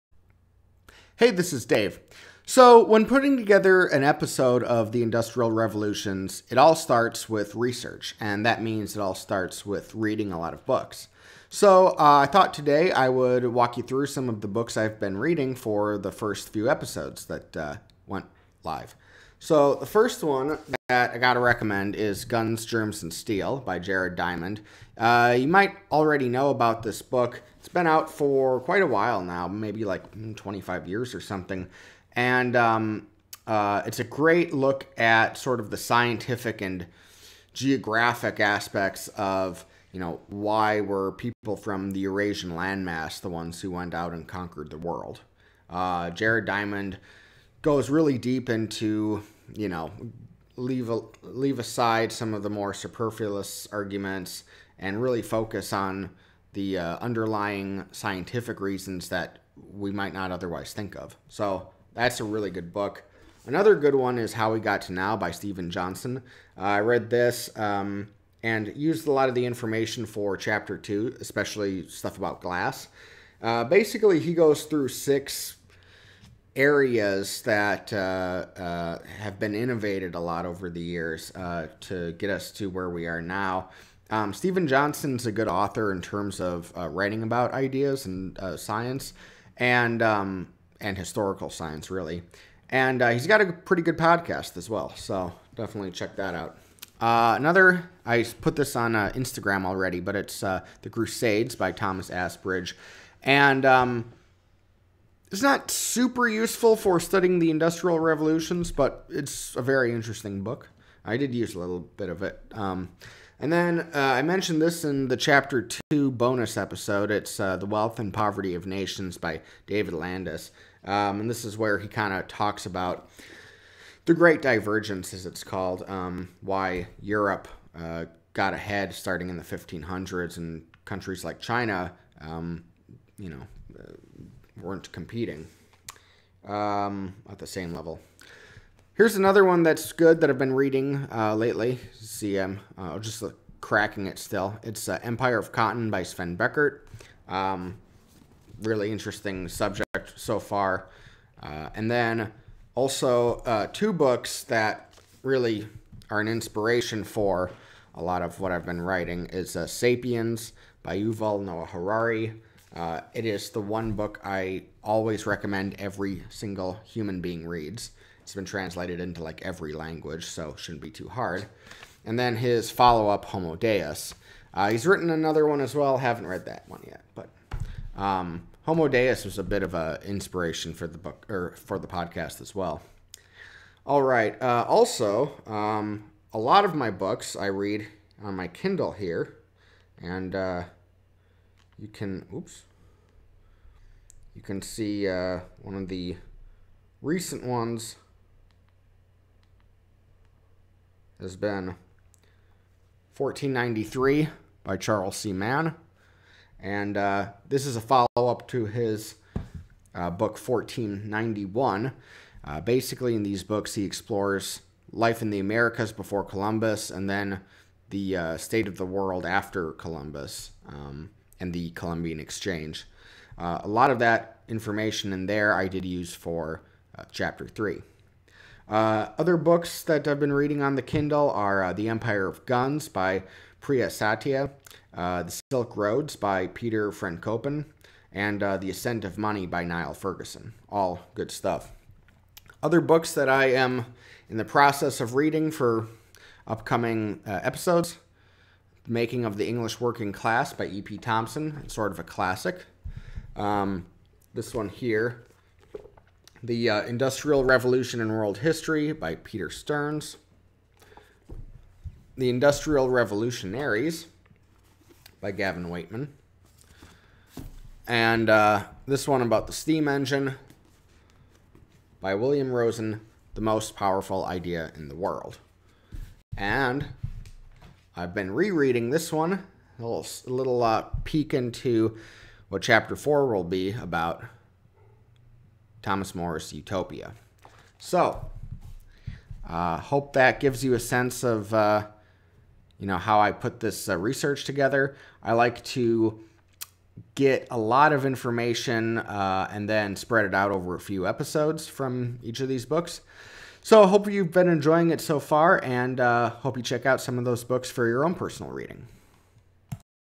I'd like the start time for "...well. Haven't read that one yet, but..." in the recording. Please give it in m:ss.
2:55.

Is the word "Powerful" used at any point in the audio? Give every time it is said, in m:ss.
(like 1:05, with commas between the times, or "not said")
4:33.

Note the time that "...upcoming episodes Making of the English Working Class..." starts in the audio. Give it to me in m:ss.
4:06.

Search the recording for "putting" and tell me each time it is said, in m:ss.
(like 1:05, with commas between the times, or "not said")
0:03.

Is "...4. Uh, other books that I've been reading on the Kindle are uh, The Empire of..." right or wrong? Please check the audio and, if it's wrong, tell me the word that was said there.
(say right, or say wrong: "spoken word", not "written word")
wrong: "3", not "4".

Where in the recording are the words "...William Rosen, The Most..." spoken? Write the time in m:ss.
4:32.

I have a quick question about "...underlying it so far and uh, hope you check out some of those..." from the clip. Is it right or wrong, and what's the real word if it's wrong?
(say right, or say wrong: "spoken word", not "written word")
wrong: "enjoying", not "underlying".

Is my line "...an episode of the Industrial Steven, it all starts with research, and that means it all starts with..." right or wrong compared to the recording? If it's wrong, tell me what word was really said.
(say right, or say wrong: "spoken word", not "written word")
wrong: "Revolutions", not "Steven".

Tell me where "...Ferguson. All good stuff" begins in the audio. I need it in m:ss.
3:59.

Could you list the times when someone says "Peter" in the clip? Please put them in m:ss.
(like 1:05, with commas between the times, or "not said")
3:56, 4:19.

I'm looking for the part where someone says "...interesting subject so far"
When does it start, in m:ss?
2:28.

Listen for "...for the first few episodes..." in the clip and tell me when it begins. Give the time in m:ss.
0:15.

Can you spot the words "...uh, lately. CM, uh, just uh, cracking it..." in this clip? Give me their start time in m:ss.
2:21.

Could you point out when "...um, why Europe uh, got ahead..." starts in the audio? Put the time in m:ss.
2:05.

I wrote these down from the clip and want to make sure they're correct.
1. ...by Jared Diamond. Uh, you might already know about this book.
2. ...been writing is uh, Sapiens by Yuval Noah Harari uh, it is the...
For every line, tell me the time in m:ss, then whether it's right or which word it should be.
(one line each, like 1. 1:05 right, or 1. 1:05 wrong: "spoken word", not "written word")
1. 0:23 right
2. 2:38 right.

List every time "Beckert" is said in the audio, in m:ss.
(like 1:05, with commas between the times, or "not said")
2:26.